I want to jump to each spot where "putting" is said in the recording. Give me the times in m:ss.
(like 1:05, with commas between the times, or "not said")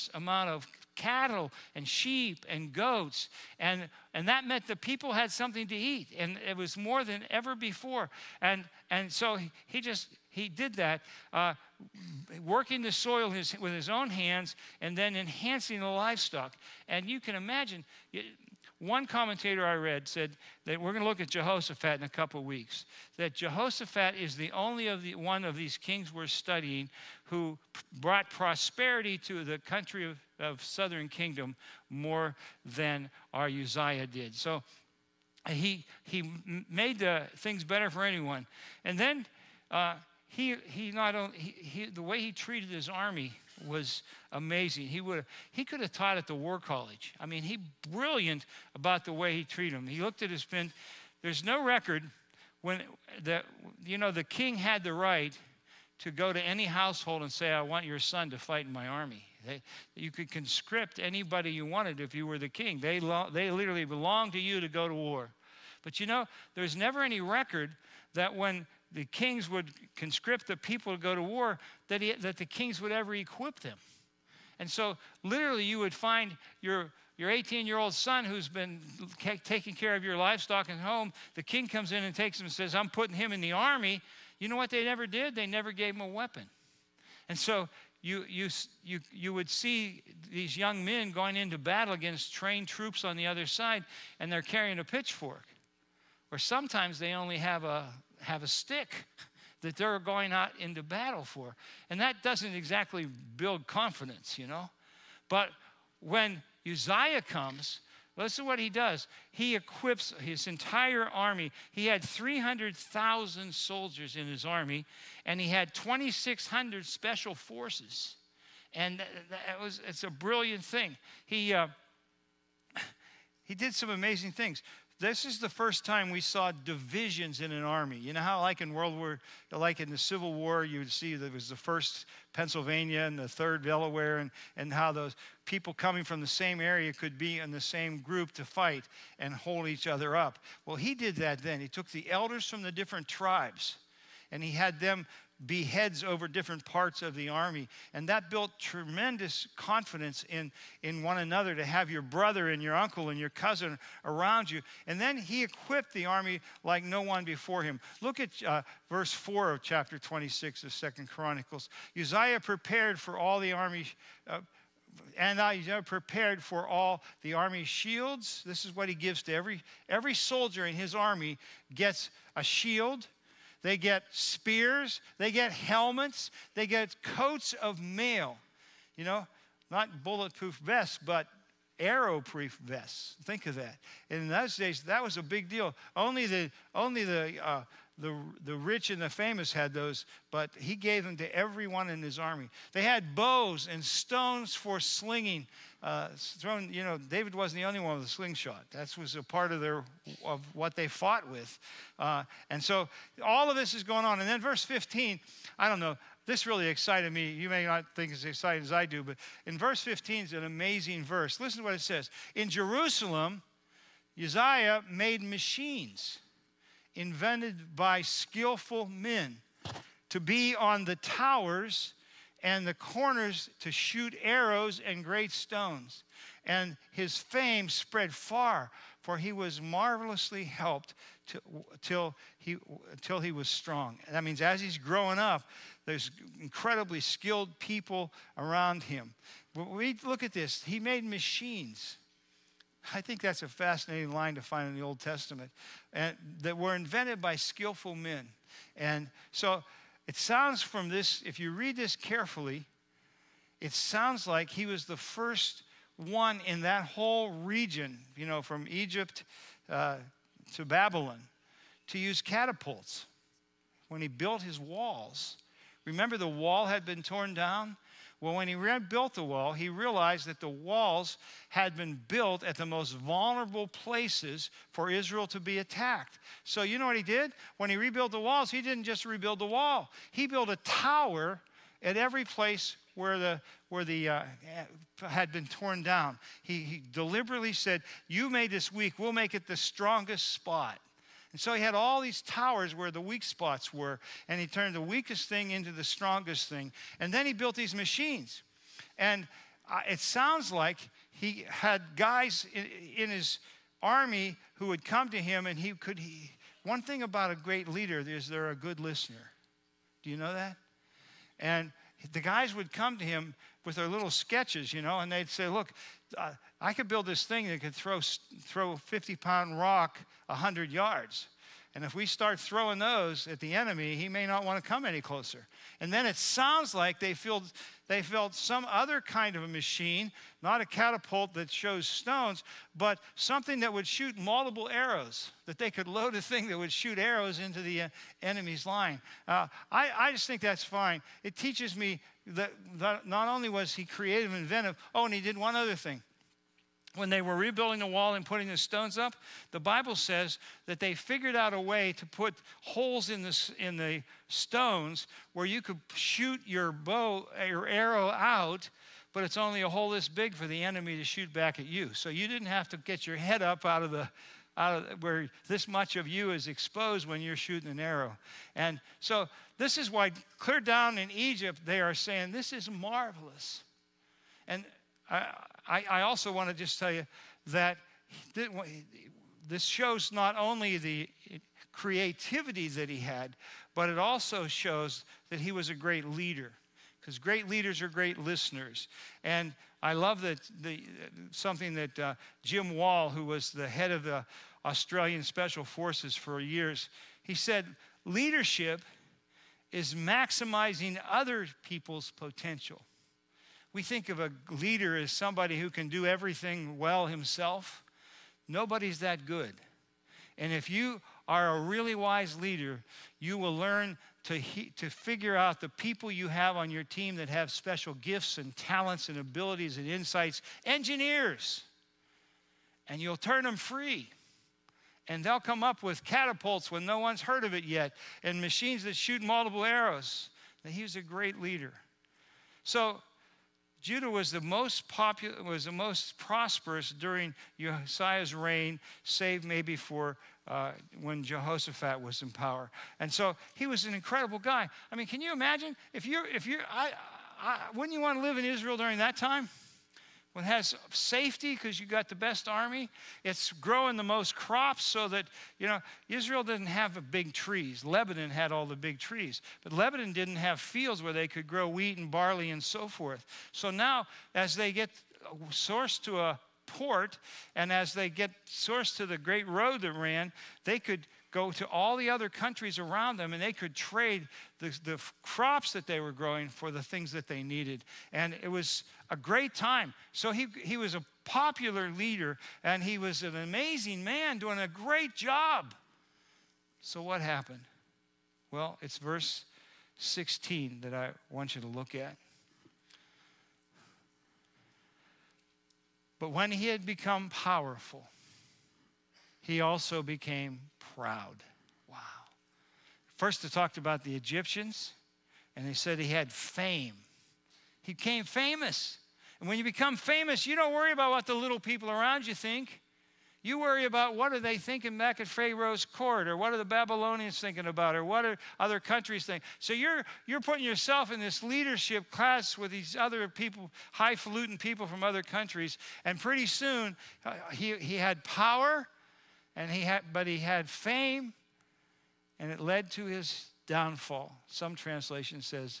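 1:22, 5:48, 8:40.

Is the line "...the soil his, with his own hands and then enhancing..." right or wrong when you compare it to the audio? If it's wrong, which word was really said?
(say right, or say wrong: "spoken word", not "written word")
right.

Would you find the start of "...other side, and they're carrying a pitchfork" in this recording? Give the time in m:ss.
1:33.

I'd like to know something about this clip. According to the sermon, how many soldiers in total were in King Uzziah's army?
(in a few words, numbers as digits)
300,000.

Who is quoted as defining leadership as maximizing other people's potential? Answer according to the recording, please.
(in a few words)
Jim Wallace.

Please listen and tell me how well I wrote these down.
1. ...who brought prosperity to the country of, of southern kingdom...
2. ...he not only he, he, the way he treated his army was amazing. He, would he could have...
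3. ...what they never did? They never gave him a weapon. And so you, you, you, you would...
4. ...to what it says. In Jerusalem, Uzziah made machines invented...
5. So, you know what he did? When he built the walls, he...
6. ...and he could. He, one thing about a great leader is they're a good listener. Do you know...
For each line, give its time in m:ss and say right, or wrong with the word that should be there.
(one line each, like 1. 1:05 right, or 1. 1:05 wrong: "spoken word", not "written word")
1. 0:27 right
2. 0:40 right
3. 1:24 right
4. 3:31 right
5. 4:36 wrong: "rebuilt", not "built"
6. 5:05 right.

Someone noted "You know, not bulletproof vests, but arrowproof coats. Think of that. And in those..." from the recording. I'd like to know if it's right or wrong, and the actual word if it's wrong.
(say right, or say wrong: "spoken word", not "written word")
wrong: "vests", not "coats".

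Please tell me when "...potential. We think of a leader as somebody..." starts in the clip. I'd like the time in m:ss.
6:42.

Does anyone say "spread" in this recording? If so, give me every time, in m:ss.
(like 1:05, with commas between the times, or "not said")
3:47.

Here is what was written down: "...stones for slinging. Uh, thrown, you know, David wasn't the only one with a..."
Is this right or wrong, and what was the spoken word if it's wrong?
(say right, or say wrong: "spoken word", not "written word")
right.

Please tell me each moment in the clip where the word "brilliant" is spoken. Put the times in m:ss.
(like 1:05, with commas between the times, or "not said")
0:47, 2:00.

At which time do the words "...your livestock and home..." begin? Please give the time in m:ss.
1:20.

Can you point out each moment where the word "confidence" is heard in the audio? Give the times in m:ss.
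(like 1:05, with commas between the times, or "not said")
1:43, 2:29.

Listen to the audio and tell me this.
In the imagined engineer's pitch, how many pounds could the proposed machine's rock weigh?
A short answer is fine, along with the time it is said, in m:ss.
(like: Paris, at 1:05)
50, at 5:18.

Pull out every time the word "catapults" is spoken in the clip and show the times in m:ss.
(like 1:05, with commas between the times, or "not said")
4:22, 5:30, 7:06.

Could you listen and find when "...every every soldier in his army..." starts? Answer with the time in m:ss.
2:49.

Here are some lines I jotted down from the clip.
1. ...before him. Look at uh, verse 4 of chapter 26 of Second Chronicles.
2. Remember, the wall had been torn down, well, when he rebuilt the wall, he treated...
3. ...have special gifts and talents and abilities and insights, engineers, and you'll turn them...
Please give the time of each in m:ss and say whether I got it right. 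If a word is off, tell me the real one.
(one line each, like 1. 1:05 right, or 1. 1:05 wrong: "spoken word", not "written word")
1. 2:37 right
2. 4:25 wrong: "realized", not "treated"
3. 6:57 right.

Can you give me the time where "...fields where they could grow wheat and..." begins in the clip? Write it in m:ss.
7:40.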